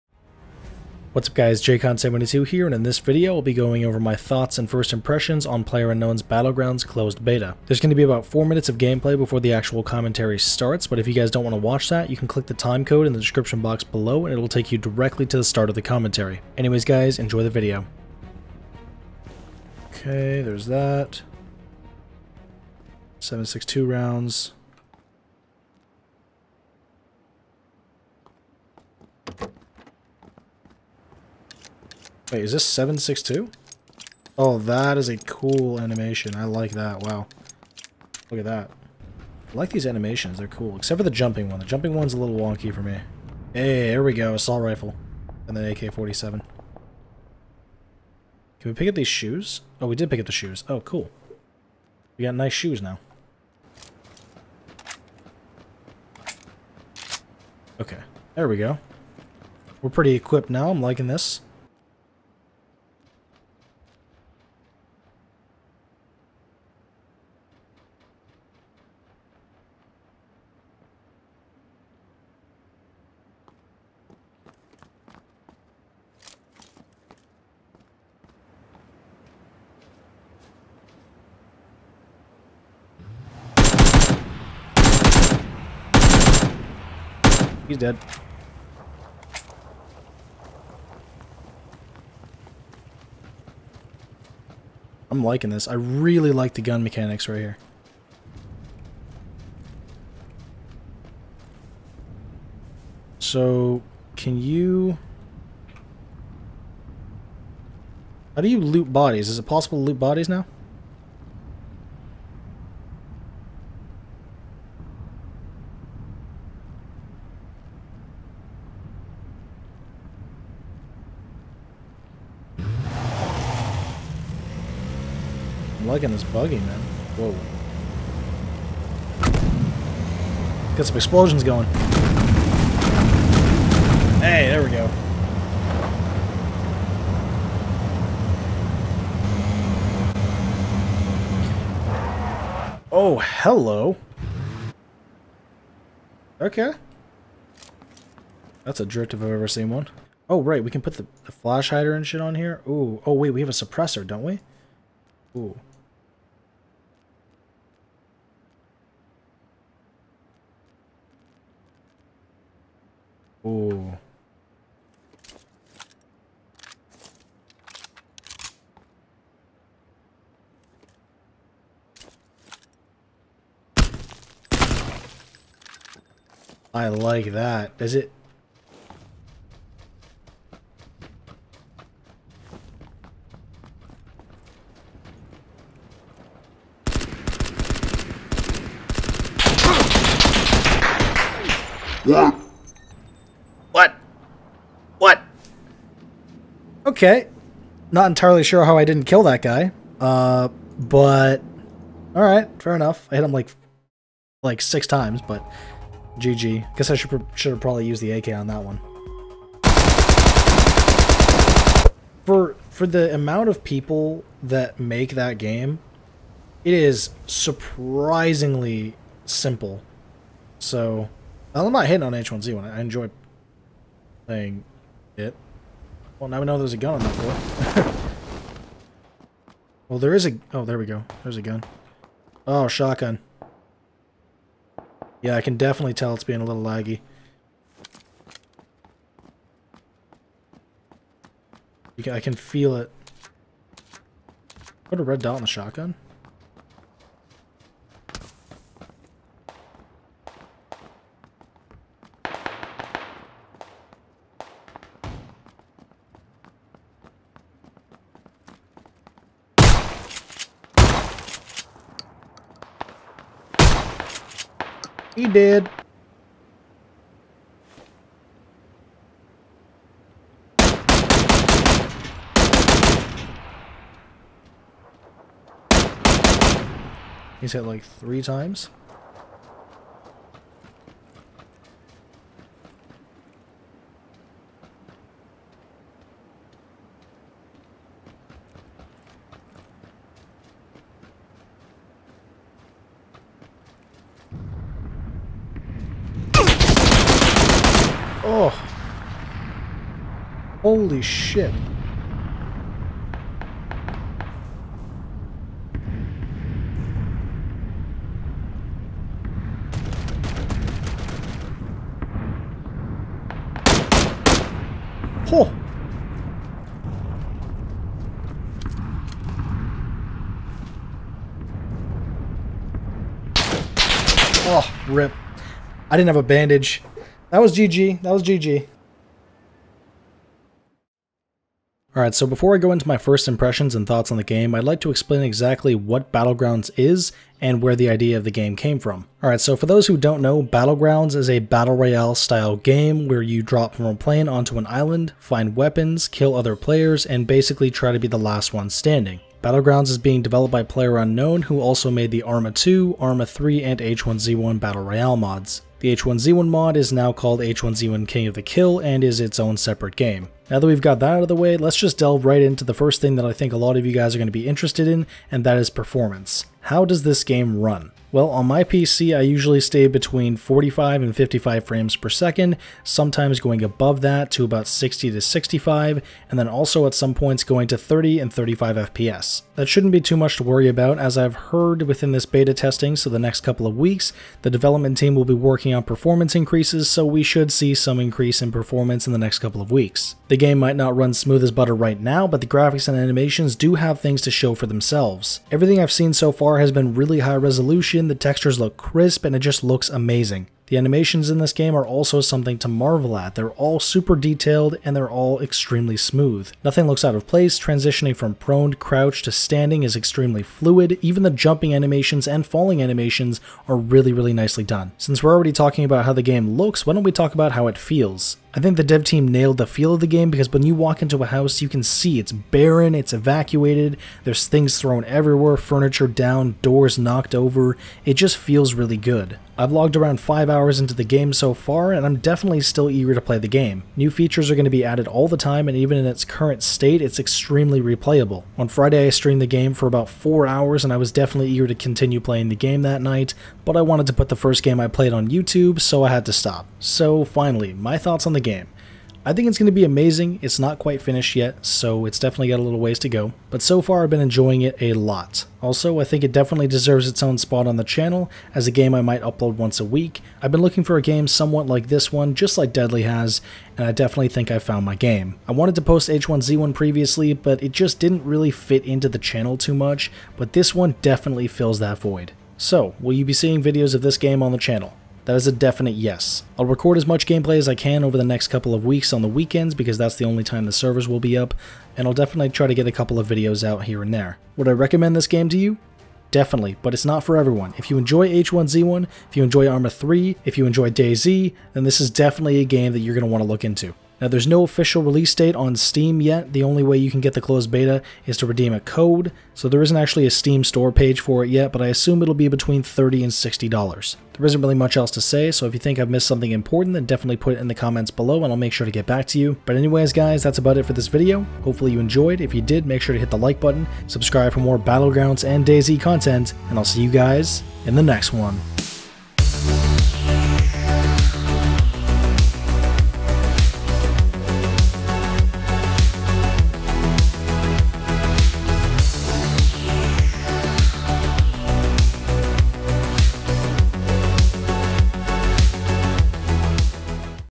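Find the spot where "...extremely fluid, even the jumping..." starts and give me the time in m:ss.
6:49.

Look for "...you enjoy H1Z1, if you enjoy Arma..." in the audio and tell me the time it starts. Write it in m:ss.
8:07.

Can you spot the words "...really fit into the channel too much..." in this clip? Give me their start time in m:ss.
7:48.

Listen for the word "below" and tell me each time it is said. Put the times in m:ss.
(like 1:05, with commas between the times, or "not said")
0:13, 8:28.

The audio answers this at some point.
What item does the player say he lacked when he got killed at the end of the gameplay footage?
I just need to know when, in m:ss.
5:26.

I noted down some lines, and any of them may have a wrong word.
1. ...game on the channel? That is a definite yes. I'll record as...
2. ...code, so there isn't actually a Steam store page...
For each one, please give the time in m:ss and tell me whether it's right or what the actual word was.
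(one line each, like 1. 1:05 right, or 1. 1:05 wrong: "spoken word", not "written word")
1. 7:54 right
2. 8:18 right.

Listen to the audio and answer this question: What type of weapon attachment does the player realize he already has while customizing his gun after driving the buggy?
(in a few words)
suppressor.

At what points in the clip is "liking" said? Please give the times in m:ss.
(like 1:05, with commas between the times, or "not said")
1:00, 1:35, 2:05.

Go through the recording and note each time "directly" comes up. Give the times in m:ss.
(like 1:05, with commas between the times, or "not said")
0:14.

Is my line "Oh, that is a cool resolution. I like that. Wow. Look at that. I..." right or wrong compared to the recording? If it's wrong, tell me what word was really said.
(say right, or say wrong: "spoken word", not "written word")
wrong: "animation", not "resolution".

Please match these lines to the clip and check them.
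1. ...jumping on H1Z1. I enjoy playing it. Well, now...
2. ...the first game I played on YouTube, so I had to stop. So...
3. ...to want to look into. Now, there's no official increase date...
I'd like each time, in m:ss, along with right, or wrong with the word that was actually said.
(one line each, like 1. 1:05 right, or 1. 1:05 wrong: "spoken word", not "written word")
1. 3:41 wrong: "hitting", not "jumping"
2. 7:24 right
3. 8:13 wrong: "release", not "increase".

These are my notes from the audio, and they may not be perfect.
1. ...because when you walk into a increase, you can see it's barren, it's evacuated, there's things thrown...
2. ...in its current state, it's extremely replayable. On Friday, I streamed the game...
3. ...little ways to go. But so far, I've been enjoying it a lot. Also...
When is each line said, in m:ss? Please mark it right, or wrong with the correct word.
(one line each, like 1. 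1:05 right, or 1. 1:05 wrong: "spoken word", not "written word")
1. 7:00 wrong: "house", not "increase"
2. 7:15 right
3. 7:32 right.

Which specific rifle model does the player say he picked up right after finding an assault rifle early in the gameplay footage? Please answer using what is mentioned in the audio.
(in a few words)
AK-47.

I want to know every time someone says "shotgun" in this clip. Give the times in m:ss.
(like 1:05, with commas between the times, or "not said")
3:52, 4:05.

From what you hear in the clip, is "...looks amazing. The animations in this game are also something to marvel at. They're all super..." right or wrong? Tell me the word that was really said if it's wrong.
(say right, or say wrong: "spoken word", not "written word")
right.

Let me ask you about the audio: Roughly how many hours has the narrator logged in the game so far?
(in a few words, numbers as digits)
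5.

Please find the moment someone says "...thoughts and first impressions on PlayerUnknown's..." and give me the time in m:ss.
0:04.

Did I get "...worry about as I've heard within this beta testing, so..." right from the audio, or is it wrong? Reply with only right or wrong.
right.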